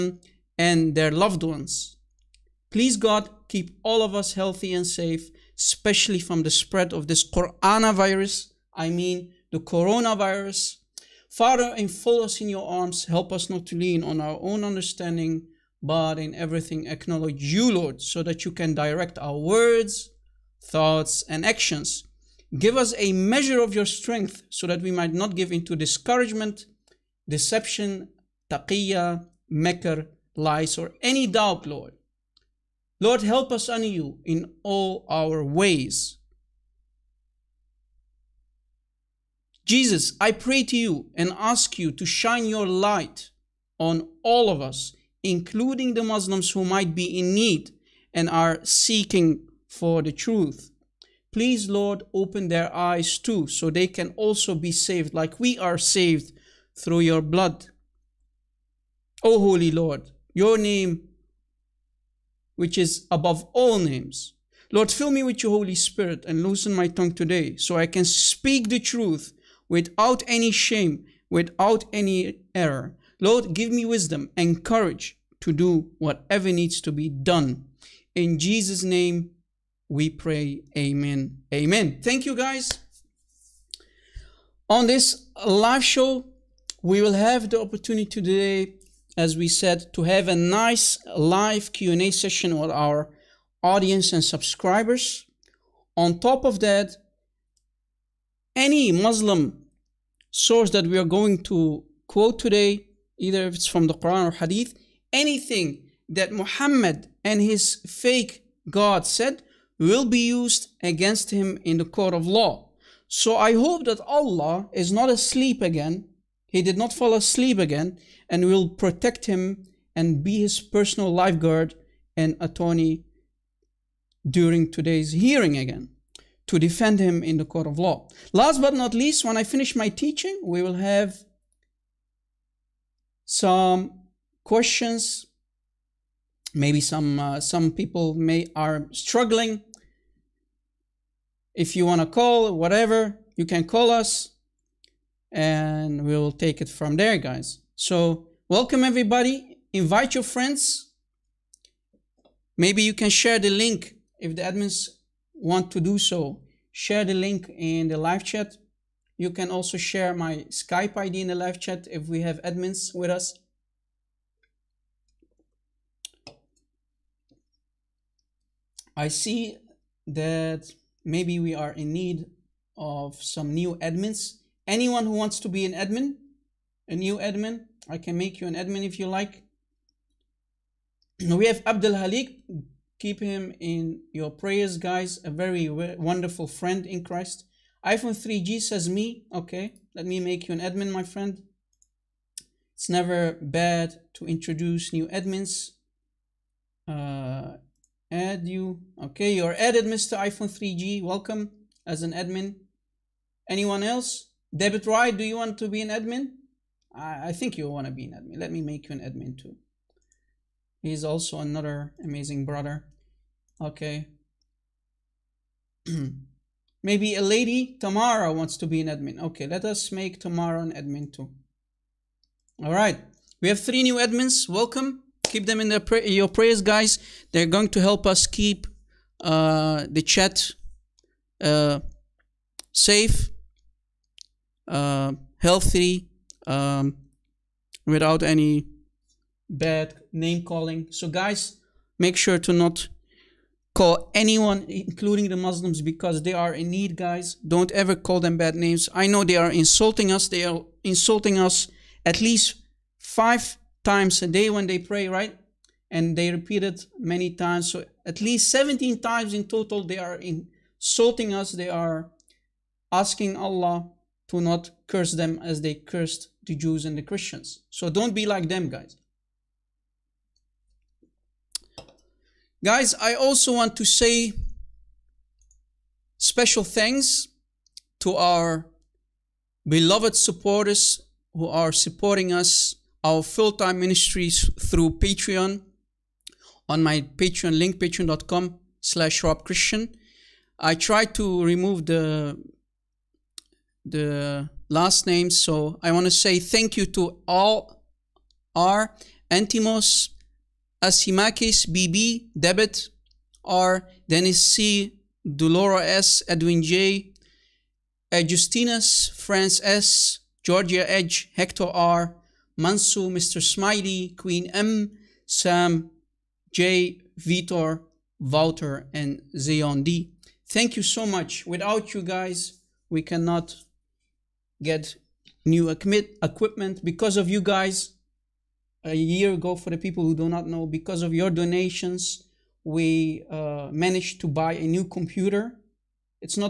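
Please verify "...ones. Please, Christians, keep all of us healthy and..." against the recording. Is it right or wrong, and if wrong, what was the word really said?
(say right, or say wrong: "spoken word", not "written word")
wrong: "God", not "Christians".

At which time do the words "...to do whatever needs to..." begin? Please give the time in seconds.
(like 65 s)
75 s.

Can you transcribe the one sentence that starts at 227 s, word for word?
They're going to help us keep uh, the chat uh, safe, uh, healthy, um, without any bad name calling.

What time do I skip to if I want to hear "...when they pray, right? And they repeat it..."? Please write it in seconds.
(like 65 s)
254 s.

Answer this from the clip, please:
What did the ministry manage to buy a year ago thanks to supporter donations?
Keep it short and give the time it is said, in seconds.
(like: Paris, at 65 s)
a new computer, at 334 s.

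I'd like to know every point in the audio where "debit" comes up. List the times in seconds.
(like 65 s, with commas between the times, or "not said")
204 s, 302 s.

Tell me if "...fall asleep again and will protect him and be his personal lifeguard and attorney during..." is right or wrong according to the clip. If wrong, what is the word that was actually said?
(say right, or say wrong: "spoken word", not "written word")
right.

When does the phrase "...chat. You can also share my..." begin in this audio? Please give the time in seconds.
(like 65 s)
158 s.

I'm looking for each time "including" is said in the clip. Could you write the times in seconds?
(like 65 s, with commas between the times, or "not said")
45 s, 244 s.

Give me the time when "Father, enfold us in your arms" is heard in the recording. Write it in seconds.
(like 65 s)
11 s.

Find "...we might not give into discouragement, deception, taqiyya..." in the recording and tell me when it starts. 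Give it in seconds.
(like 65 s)
24 s.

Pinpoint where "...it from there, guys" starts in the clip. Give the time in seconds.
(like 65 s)
146 s.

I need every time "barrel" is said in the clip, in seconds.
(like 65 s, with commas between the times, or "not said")
not said.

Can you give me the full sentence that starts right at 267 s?
So don't be like them, guys.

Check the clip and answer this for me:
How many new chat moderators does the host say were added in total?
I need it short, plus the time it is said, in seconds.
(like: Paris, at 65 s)
3, at 223 s.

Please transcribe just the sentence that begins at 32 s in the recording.
Lord, help us on you in all our ways.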